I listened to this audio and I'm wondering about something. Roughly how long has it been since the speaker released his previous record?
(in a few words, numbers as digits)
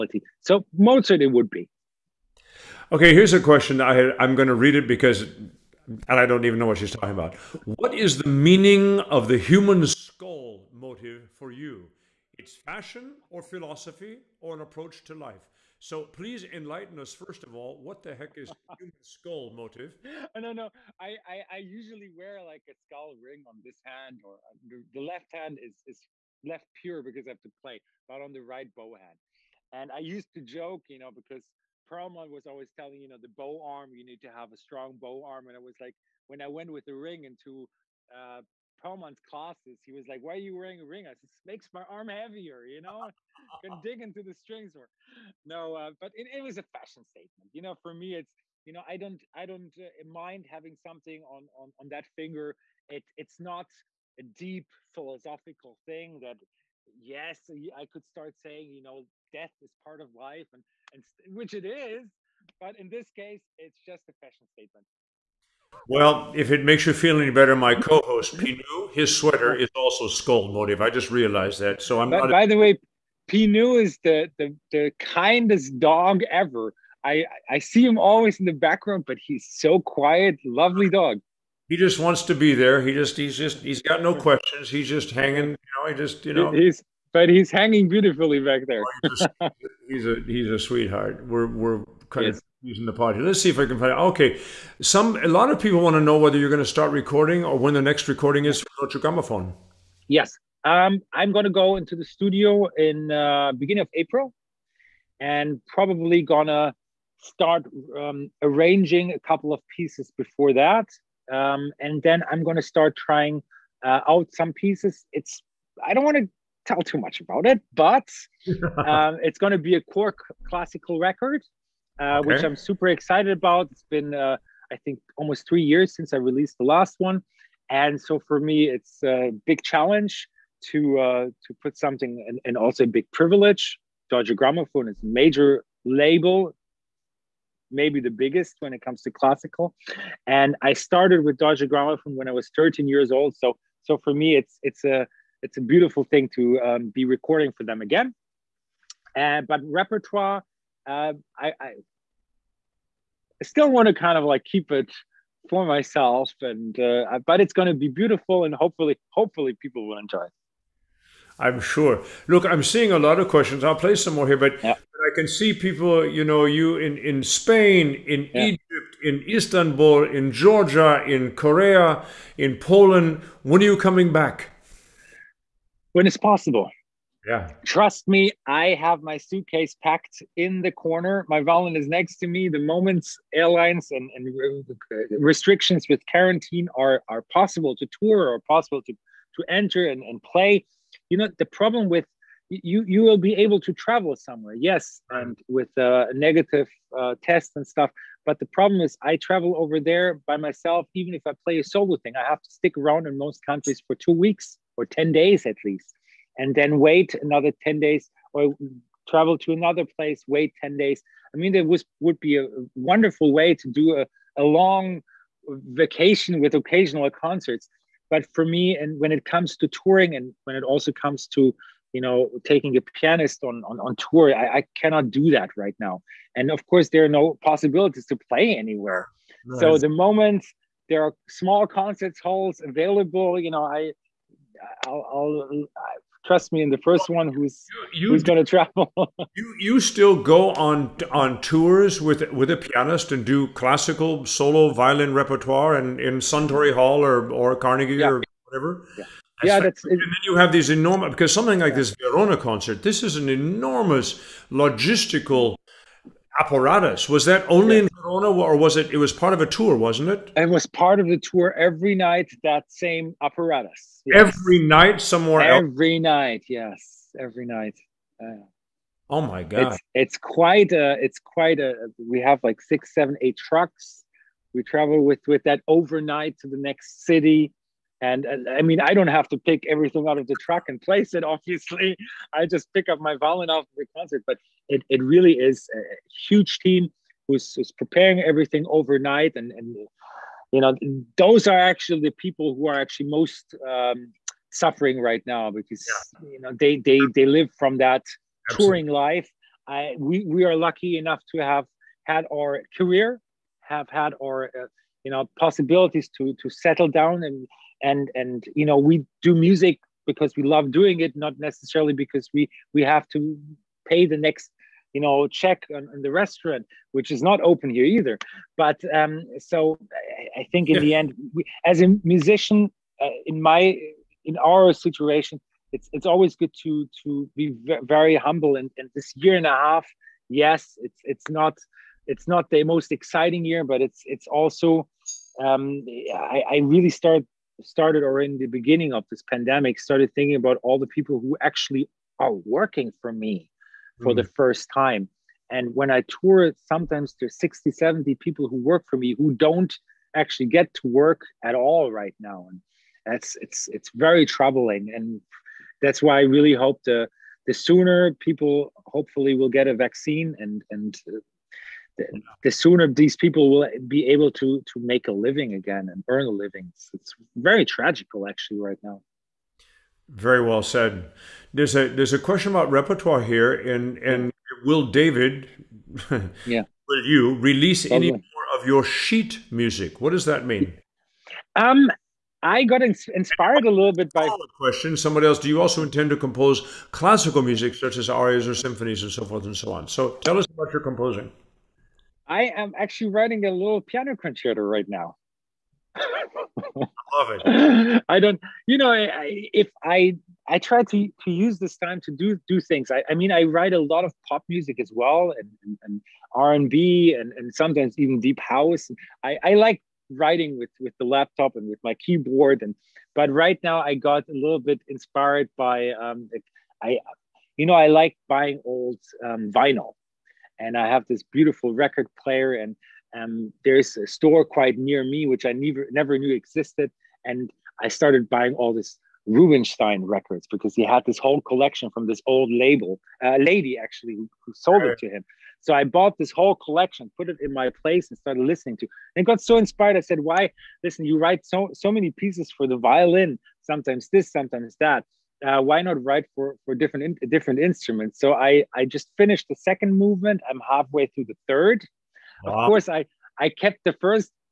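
Almost 3 years.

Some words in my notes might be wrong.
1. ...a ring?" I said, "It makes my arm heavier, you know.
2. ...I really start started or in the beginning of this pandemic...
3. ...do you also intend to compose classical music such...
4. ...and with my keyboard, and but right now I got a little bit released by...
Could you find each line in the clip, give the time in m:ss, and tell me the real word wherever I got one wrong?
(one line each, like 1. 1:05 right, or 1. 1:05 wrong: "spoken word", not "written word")
1. 0:40 right
2. 5:36 right
3. 6:25 right
4. 6:51 wrong: "inspired", not "released".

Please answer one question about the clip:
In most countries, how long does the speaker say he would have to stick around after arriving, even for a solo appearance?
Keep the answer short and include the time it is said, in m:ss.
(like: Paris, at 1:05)
2 weeks, at 3:23.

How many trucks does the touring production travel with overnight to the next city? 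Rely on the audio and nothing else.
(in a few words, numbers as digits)
6, 7, 8 trucks.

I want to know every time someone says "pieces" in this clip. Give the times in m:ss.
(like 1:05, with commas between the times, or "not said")
1:49, 1:54, 7:22.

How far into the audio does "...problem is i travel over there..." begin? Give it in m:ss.
3:18.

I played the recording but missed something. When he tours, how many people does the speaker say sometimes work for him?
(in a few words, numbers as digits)
60 or 70.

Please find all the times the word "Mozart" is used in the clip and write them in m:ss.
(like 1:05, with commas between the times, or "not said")
0:00.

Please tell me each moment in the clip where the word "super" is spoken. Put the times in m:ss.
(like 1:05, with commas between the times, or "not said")
2:02.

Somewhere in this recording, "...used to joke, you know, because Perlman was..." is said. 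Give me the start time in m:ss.
0:29.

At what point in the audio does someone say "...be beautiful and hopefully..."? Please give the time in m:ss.
2:37.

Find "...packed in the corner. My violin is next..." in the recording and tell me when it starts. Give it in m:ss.
2:59.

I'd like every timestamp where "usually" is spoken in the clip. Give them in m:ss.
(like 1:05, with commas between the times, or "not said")
0:21.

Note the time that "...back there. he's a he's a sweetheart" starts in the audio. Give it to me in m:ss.
1:28.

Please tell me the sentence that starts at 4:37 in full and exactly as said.
And, and I mean, I don't have to pick everything out of the truck and place it.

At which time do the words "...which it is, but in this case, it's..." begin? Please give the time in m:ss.
1:01.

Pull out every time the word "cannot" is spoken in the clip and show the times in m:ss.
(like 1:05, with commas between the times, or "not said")
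3:44.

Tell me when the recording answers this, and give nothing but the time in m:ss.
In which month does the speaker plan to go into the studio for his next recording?
1:43.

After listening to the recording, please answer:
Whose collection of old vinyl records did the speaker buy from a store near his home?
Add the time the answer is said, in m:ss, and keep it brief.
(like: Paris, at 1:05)
Rubinstein, at 7:09.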